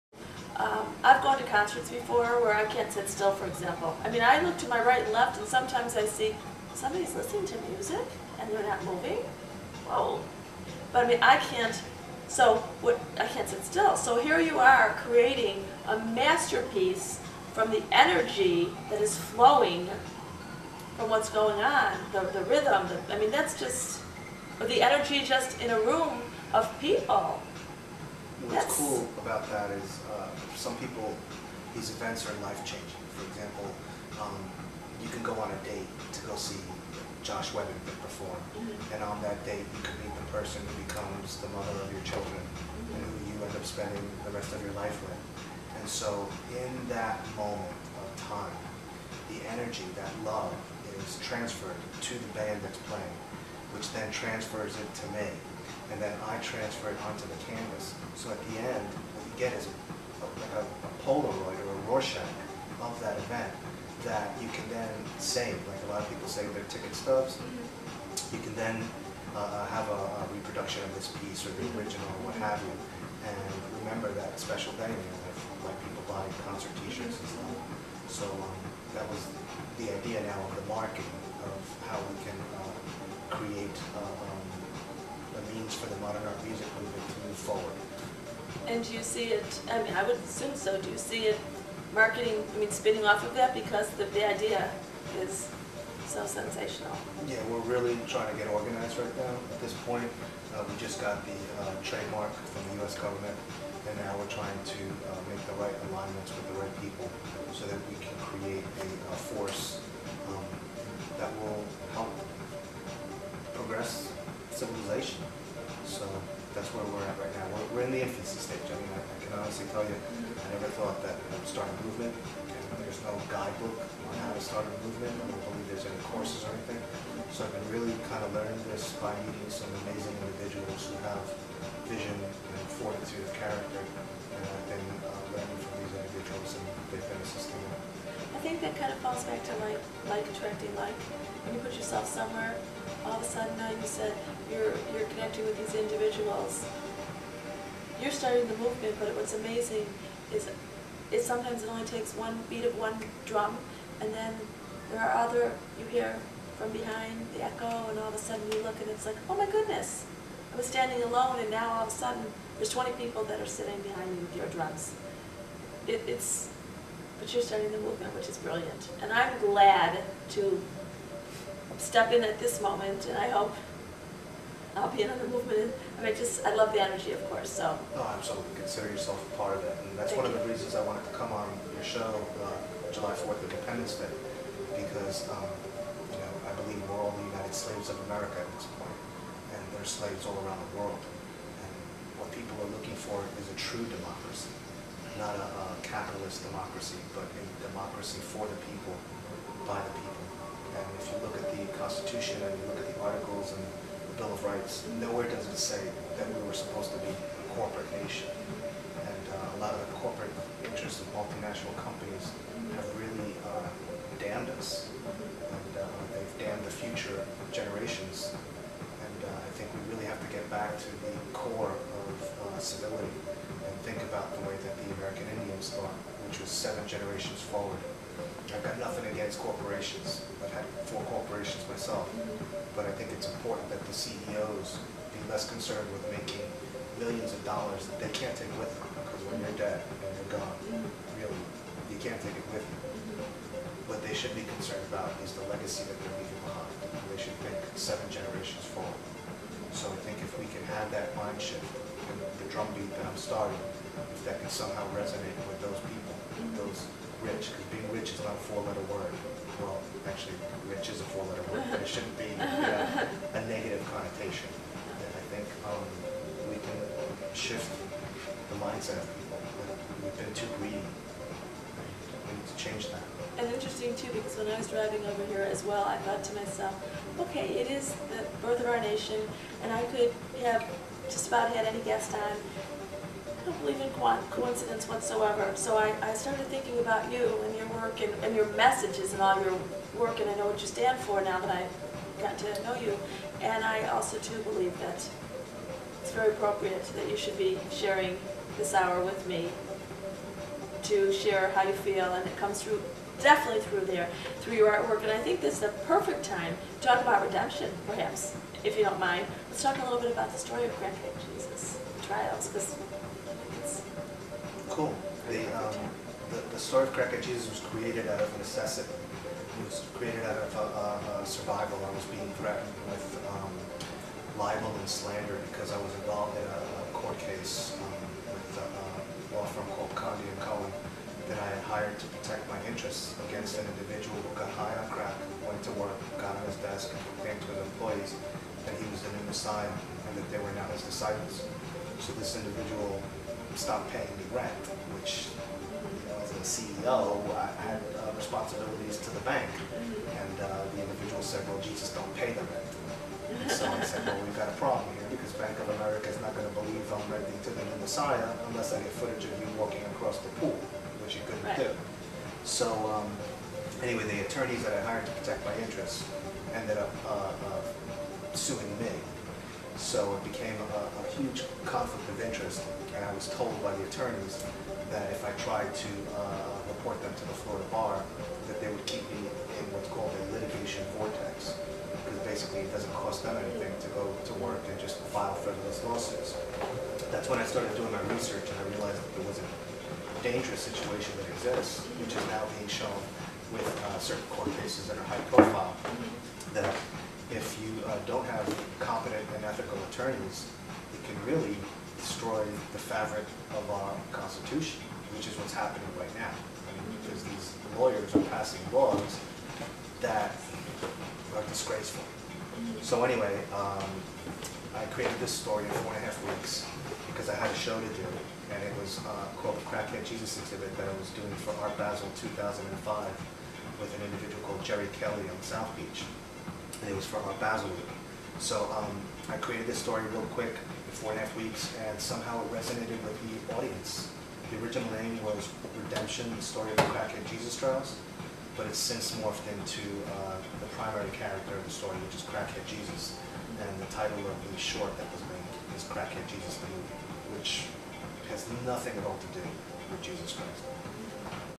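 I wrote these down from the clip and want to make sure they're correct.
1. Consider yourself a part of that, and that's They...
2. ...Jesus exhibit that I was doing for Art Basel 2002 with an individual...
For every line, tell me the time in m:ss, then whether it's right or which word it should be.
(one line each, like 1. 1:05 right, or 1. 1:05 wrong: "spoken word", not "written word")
1. 2:58 wrong: "Thank", not "They"
2. 7:00 wrong: "2005", not "2002".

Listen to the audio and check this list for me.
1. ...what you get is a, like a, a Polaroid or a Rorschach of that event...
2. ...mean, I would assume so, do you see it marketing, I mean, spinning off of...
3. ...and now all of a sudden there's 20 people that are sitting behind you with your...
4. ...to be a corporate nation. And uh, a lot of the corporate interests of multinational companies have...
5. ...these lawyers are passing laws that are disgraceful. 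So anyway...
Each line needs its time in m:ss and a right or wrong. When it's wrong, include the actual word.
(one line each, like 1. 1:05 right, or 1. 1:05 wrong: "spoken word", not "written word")
1. 0:59 right
2. 1:29 right
3. 2:41 right
4. 3:26 right
5. 6:47 right.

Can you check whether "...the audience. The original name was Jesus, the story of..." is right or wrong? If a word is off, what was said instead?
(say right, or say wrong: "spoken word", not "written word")
wrong: "Redemption", not "Jesus".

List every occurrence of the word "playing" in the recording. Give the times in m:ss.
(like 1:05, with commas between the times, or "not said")
0:52.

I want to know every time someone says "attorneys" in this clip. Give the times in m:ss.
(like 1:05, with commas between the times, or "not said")
6:04, 6:13, 6:39.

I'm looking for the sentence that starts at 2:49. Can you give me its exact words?
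And I'm glad to step in at this moment, and I hope I'll be another movement.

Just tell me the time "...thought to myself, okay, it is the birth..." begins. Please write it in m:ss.
4:36.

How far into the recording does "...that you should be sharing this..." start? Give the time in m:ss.
4:56.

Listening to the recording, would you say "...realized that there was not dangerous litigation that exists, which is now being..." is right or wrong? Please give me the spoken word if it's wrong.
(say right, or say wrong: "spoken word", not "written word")
wrong: "situation", not "litigation".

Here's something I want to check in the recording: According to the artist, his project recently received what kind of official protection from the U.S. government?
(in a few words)
trademark.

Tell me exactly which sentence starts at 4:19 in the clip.
Well, actually, which is a four-letter word, but it shouldn't be uh, a negative connotation.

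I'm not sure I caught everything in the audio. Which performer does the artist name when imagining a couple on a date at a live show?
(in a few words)
Josh Webber.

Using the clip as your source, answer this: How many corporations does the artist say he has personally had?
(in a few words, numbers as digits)
4.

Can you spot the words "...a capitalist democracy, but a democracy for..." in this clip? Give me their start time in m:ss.
3:15.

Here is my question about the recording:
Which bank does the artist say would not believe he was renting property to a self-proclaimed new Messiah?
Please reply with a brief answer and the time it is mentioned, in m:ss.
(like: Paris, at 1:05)
Bank of America, at 5:55.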